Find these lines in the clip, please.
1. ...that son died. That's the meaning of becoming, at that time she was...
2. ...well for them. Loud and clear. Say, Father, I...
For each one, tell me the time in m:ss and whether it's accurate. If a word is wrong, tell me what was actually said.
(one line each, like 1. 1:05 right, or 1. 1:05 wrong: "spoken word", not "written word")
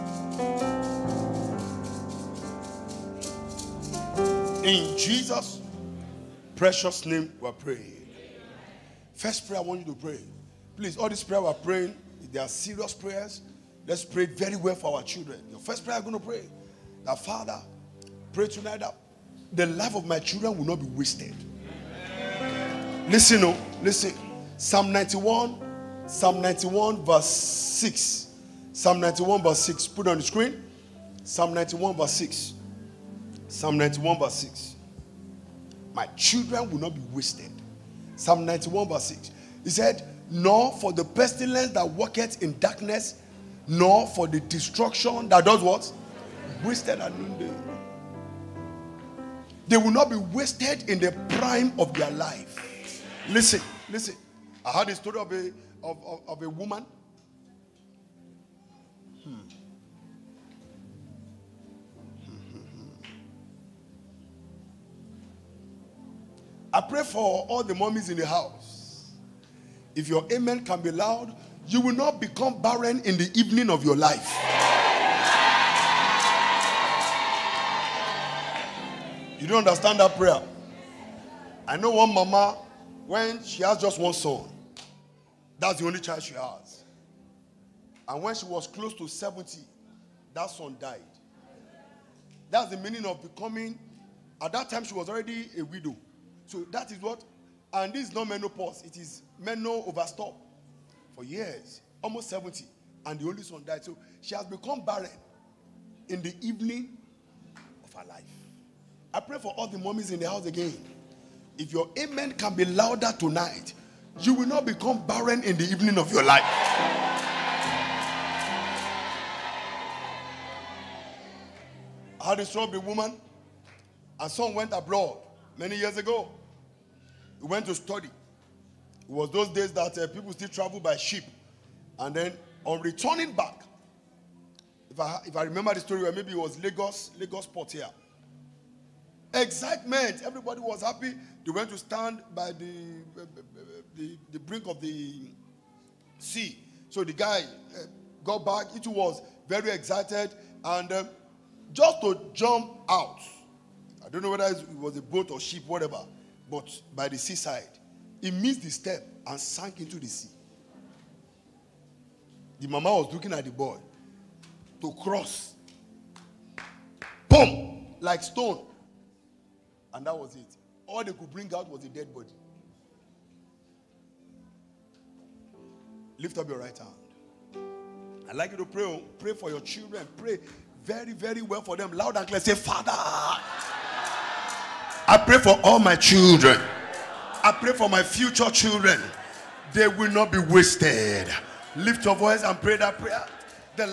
1. 1:30 right
2. 3:01 right.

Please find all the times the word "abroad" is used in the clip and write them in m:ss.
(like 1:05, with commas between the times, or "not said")
2:04.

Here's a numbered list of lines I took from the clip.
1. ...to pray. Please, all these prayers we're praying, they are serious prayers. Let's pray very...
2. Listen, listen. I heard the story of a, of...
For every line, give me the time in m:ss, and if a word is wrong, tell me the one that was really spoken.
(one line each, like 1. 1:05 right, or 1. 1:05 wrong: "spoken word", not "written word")
1. 0:09 right
2. 0:53 right.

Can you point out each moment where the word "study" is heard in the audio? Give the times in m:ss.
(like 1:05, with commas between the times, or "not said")
2:07.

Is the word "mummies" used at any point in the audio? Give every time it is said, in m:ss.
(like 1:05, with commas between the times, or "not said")
1:07, 1:49.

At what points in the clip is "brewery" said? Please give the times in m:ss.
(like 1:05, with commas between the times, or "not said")
not said.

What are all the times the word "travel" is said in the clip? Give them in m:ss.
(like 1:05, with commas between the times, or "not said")
2:10.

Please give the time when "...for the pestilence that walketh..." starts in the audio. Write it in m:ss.
0:40.